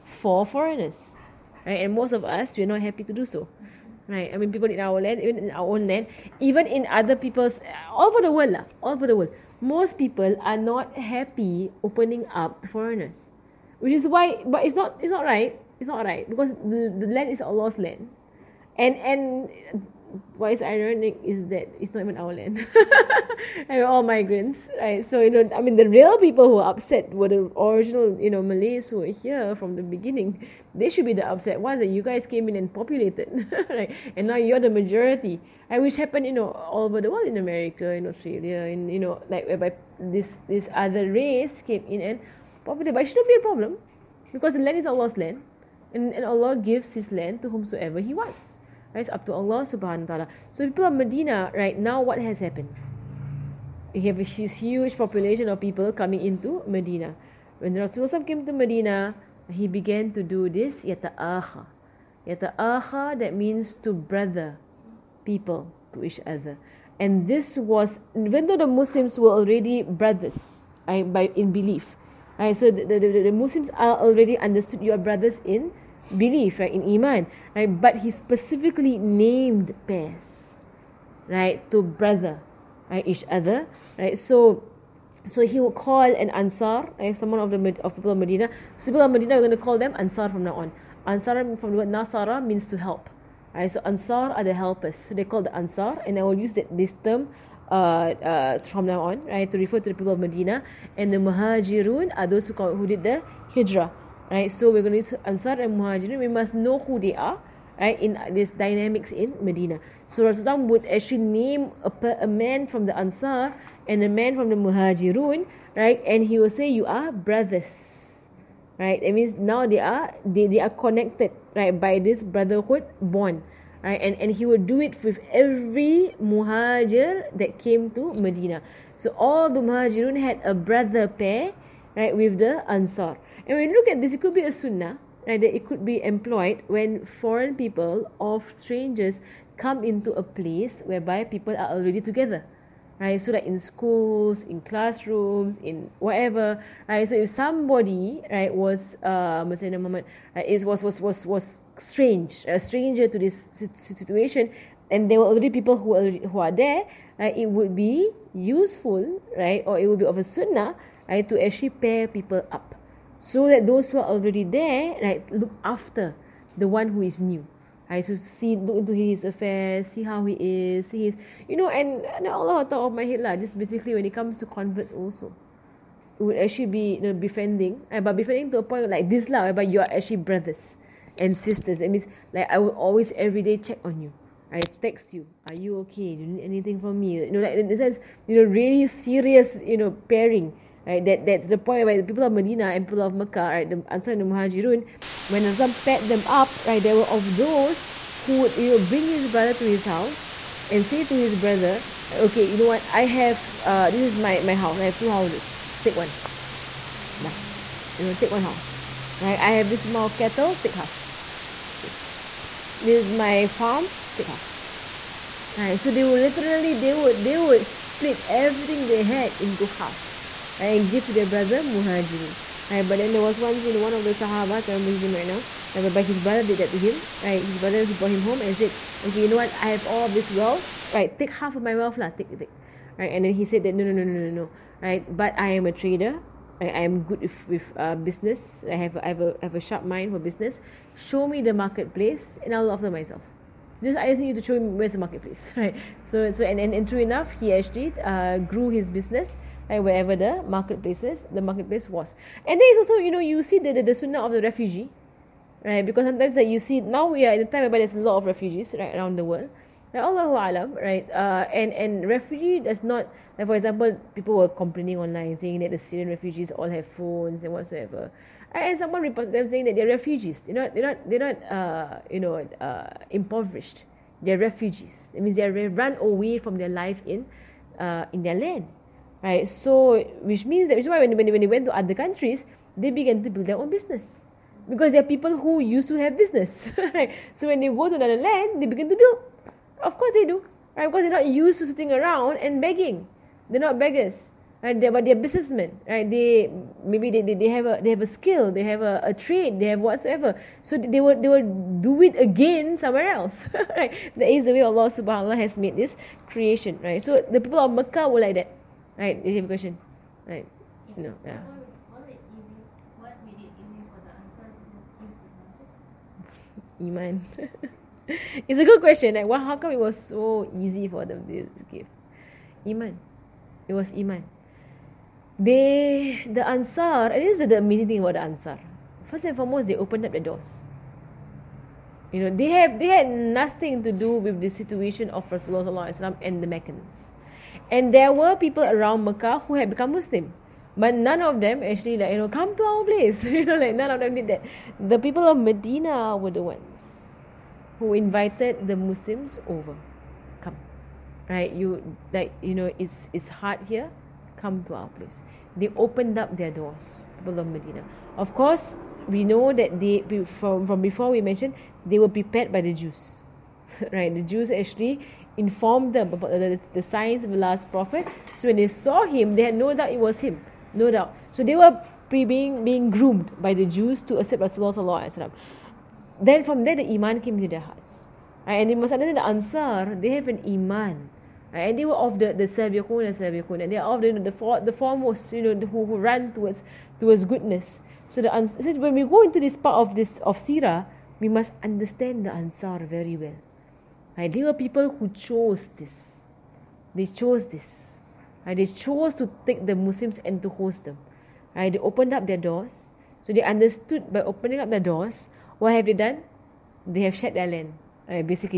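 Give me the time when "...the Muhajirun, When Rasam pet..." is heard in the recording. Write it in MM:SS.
03:14.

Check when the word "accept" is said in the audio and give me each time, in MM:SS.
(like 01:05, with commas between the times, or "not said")
06:14.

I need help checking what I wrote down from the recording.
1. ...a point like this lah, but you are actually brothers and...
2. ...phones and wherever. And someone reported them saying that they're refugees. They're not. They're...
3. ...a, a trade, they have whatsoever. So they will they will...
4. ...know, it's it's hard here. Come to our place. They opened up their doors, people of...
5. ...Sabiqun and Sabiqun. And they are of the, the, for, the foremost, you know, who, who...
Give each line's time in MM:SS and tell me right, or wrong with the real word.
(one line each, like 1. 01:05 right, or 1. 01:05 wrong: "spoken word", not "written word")
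1. 02:58 right
2. 04:26 wrong: "whatsoever", not "wherever"
3. 04:58 right
4. 05:52 right
5. 06:22 right.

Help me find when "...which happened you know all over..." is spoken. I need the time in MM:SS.
00:35.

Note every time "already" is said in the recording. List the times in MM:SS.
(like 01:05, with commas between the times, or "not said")
01:09, 01:13, 02:21, 02:35, 02:44.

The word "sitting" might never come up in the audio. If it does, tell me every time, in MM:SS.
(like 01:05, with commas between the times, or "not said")
04:51.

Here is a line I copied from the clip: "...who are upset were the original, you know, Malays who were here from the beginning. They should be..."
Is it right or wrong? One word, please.
right.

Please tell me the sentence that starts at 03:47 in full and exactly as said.
Right, his brother who brought him home and said, okay, you know what?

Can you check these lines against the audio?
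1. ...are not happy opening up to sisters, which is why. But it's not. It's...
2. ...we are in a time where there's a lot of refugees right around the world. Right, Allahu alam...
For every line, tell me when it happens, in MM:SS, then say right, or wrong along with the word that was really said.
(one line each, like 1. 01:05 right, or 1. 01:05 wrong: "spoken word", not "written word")
1. 00:10 wrong: "foreigners", not "sisters"
2. 04:17 right.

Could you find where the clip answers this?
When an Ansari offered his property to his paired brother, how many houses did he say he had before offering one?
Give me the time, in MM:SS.
03:24.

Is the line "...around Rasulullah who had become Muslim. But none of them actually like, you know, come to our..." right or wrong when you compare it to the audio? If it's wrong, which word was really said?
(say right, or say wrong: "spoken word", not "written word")
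wrong: "Mecca", not "Rasulullah".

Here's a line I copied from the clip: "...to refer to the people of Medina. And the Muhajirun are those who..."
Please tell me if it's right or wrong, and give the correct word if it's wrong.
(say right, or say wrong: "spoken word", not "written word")
right.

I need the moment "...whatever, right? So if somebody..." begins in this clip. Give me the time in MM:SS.
02:25.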